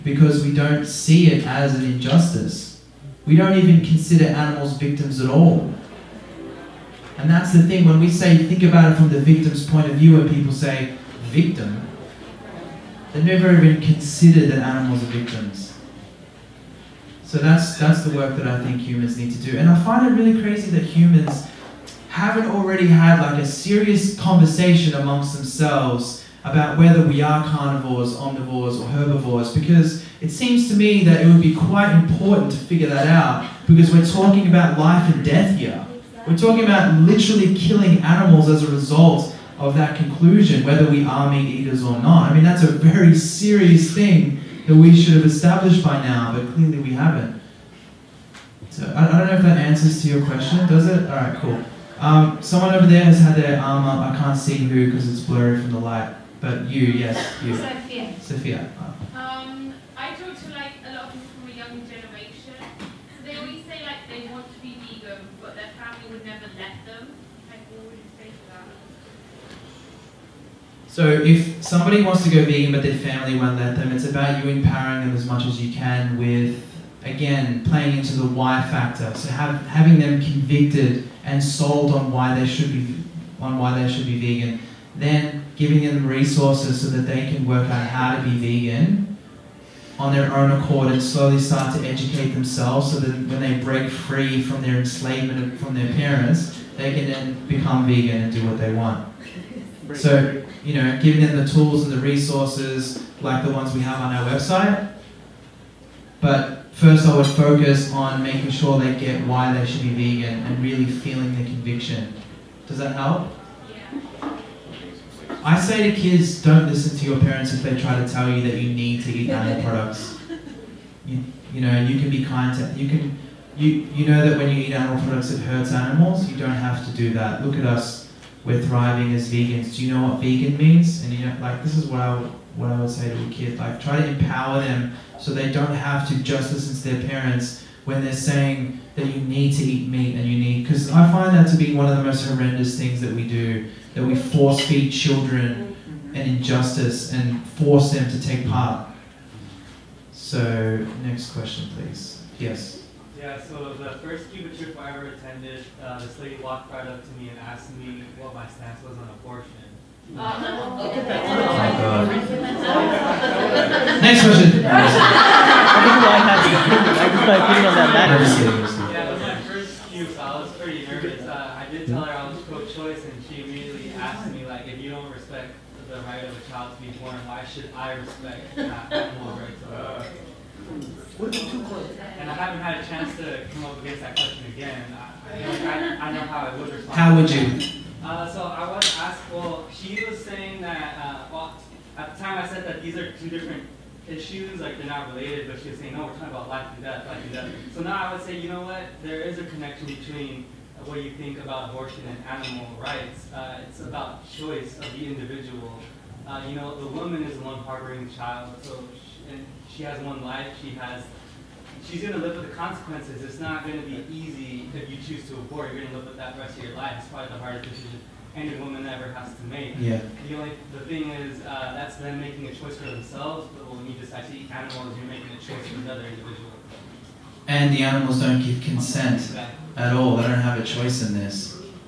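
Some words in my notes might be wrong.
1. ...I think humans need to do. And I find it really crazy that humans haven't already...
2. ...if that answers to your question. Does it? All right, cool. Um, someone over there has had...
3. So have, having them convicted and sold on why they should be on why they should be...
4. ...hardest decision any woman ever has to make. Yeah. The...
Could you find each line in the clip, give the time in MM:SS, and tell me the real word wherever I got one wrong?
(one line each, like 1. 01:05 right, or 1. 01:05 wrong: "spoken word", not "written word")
1. 00:18 right
2. 00:49 right
3. 01:19 right
4. 03:37 right.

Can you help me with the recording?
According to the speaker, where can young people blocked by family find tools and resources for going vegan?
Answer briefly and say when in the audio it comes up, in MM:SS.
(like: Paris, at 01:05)
our website, at 01:44.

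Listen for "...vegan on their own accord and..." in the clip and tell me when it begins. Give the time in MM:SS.
01:28.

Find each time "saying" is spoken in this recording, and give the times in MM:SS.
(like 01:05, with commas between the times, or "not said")
02:18, 03:10, 03:15.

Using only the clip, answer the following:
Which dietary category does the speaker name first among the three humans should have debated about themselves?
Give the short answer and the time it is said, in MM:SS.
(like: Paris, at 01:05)
carnivores, at 00:27.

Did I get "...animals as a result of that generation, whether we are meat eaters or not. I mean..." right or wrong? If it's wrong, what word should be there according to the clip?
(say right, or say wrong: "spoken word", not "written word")
wrong: "conclusion", not "generation".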